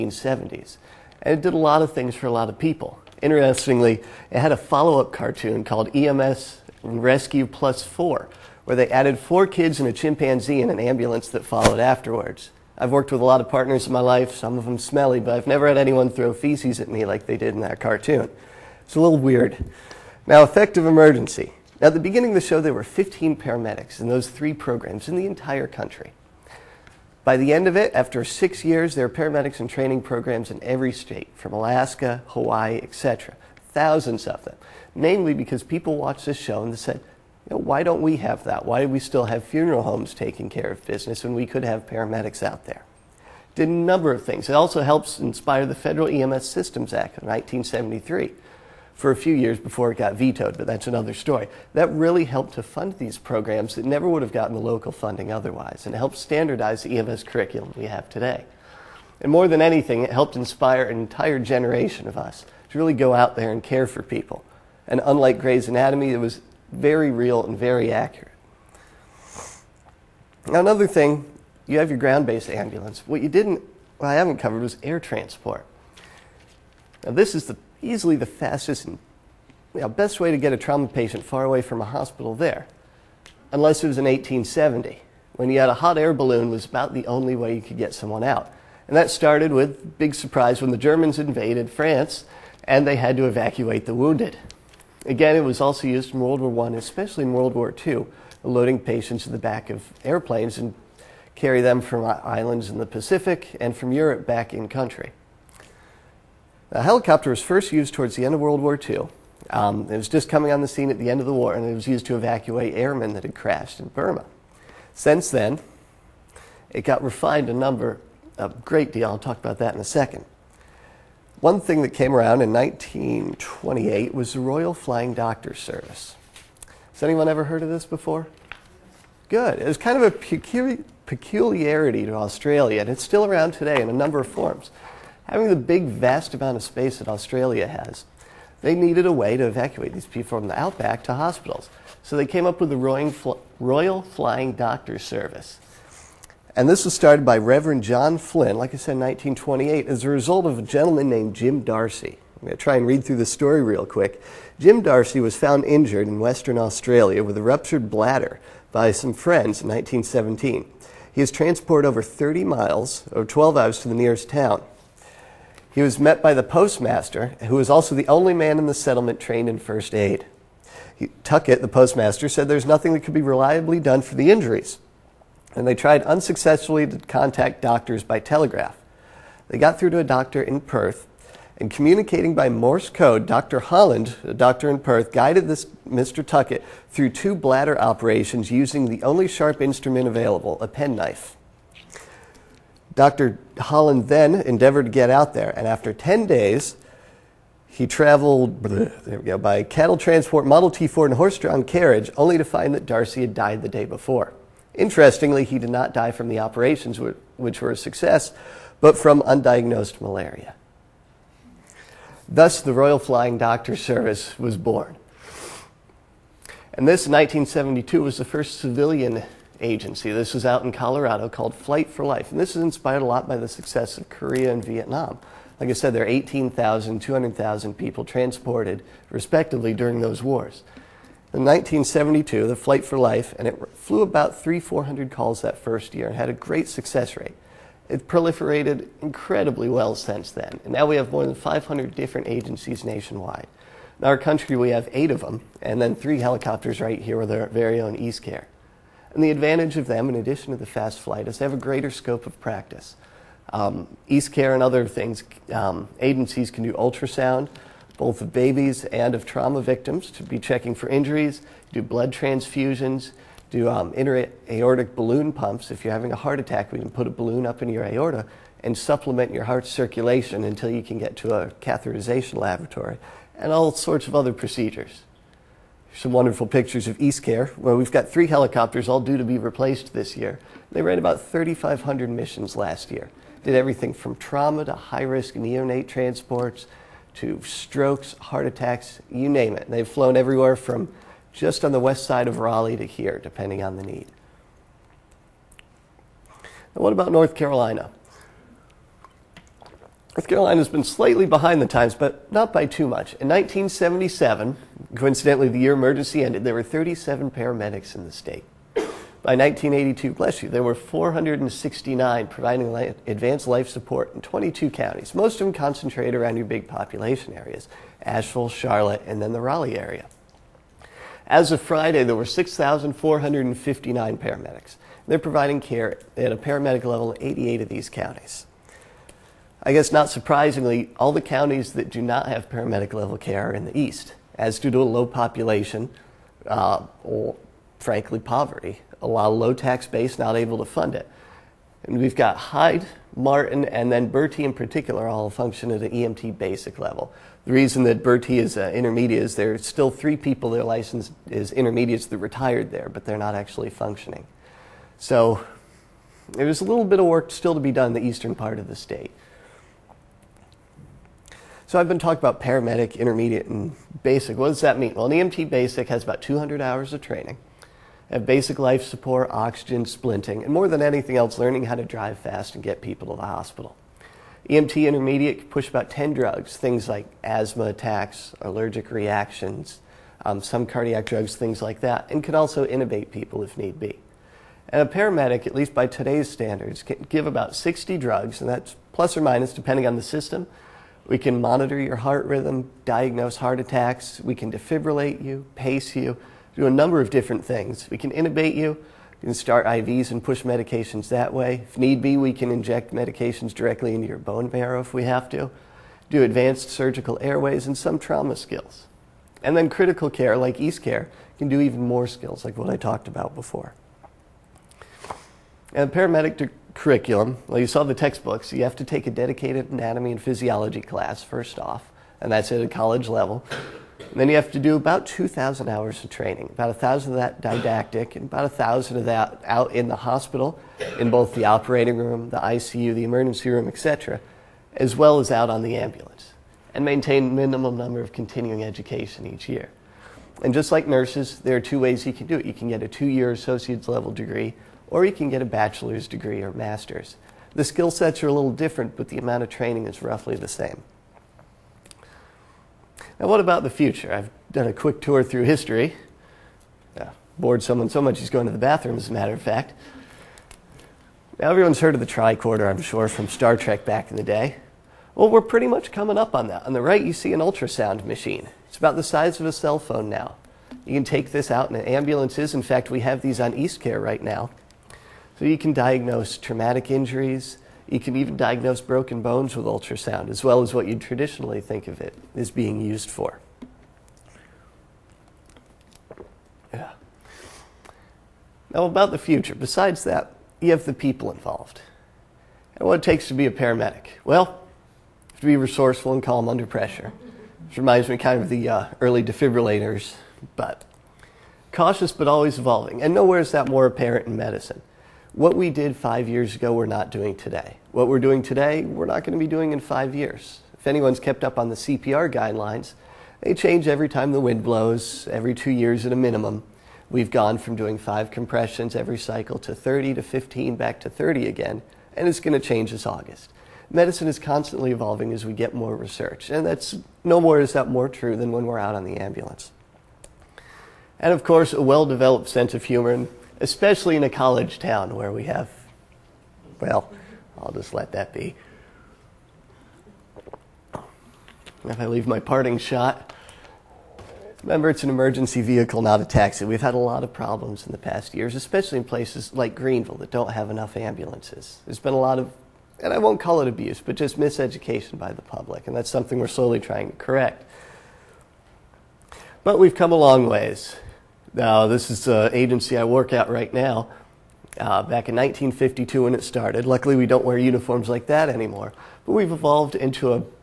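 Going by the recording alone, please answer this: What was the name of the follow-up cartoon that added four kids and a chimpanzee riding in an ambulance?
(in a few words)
EMS Rescue Plus Four.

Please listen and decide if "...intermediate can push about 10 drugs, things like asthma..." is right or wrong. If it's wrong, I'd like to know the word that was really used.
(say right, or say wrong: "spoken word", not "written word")
right.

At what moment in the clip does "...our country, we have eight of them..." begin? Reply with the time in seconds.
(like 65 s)
244 s.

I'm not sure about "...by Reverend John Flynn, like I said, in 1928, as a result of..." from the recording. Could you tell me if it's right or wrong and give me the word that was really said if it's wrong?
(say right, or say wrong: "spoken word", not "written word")
right.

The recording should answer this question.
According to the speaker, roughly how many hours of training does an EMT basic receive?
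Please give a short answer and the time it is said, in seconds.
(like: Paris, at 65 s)
200, at 366 s.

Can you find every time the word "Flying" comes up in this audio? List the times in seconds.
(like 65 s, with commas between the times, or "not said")
124 s, 144 s, 212 s.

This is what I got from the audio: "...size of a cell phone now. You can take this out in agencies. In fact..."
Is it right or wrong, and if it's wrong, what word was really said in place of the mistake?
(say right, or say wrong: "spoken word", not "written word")
wrong: "ambulances", not "agencies".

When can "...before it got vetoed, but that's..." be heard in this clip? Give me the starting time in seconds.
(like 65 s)
49 s.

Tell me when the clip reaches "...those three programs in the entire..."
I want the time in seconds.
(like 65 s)
24 s.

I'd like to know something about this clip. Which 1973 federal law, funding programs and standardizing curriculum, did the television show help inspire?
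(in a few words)
Federal EMS Systems Act.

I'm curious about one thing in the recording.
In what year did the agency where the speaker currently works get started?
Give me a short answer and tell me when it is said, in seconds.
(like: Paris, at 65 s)
1952, at 565 s.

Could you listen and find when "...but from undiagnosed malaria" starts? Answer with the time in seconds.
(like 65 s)
208 s.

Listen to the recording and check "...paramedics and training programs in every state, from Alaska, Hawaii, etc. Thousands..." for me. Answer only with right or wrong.
right.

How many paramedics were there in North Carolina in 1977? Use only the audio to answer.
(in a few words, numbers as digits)
37.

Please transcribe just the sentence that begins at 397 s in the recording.
We can intubate you, we can start IVs and push medications that way.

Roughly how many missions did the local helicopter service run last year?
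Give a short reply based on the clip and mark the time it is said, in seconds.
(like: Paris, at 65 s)
3,500, at 281 s.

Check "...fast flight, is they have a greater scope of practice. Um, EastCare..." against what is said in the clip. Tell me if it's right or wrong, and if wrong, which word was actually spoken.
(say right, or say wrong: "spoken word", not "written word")
right.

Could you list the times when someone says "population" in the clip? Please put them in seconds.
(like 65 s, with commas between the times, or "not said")
316 s, 335 s.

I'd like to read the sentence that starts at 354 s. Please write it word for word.
So there's a little bit of work still to be done in the eastern part of the state.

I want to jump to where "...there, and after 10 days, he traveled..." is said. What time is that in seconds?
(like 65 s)
195 s.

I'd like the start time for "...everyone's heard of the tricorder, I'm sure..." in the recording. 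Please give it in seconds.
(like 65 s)
461 s.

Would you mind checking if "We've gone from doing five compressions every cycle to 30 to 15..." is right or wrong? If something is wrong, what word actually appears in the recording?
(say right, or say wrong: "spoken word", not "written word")
right.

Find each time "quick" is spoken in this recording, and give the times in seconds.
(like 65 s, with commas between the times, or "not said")
153 s, 454 s.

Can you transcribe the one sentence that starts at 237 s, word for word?
It proliferated incredibly well since then.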